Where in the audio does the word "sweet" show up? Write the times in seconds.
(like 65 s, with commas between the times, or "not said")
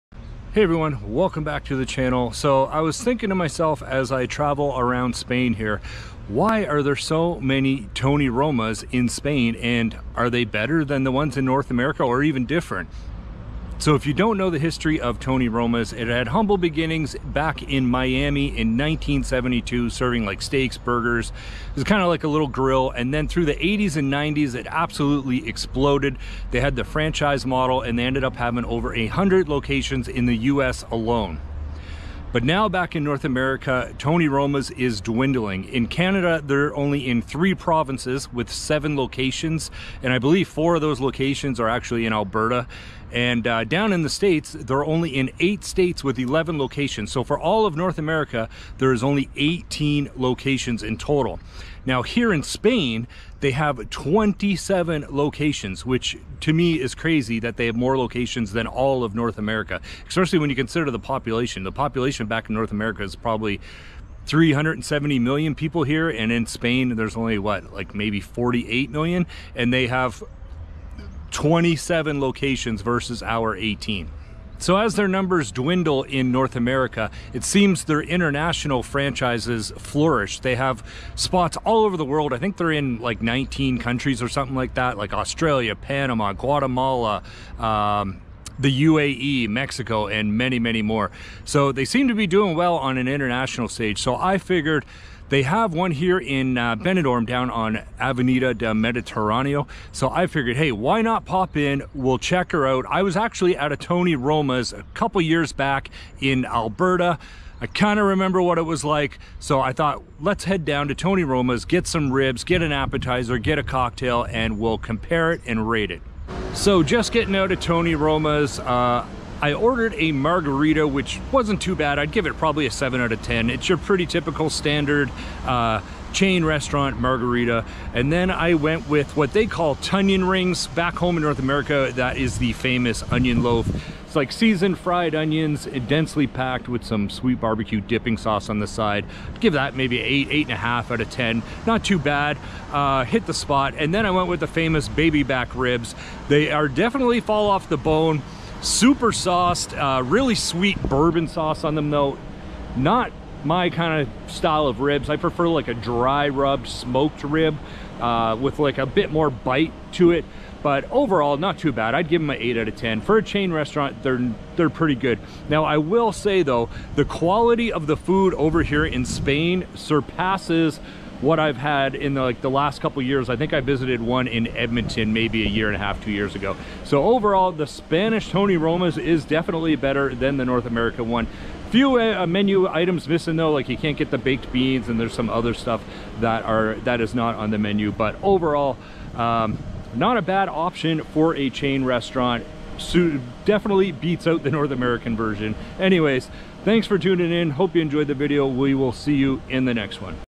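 137 s, 150 s.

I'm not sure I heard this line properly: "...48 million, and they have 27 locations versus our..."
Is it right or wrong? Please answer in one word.
right.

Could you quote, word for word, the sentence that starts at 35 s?
In Canada, they're only in three provinces with seven locations, and I believe four of those locations are actually in Alberta.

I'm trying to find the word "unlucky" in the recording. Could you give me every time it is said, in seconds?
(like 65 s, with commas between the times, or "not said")
not said.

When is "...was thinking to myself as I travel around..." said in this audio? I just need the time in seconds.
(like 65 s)
2 s.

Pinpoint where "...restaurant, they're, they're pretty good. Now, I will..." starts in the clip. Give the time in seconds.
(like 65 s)
163 s.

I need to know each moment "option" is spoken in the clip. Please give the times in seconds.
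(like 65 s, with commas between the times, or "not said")
190 s.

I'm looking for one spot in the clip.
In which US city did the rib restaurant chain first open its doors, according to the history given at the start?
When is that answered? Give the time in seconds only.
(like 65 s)
17 s.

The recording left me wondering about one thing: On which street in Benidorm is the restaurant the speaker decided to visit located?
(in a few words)
Avenida de Mediterráneo.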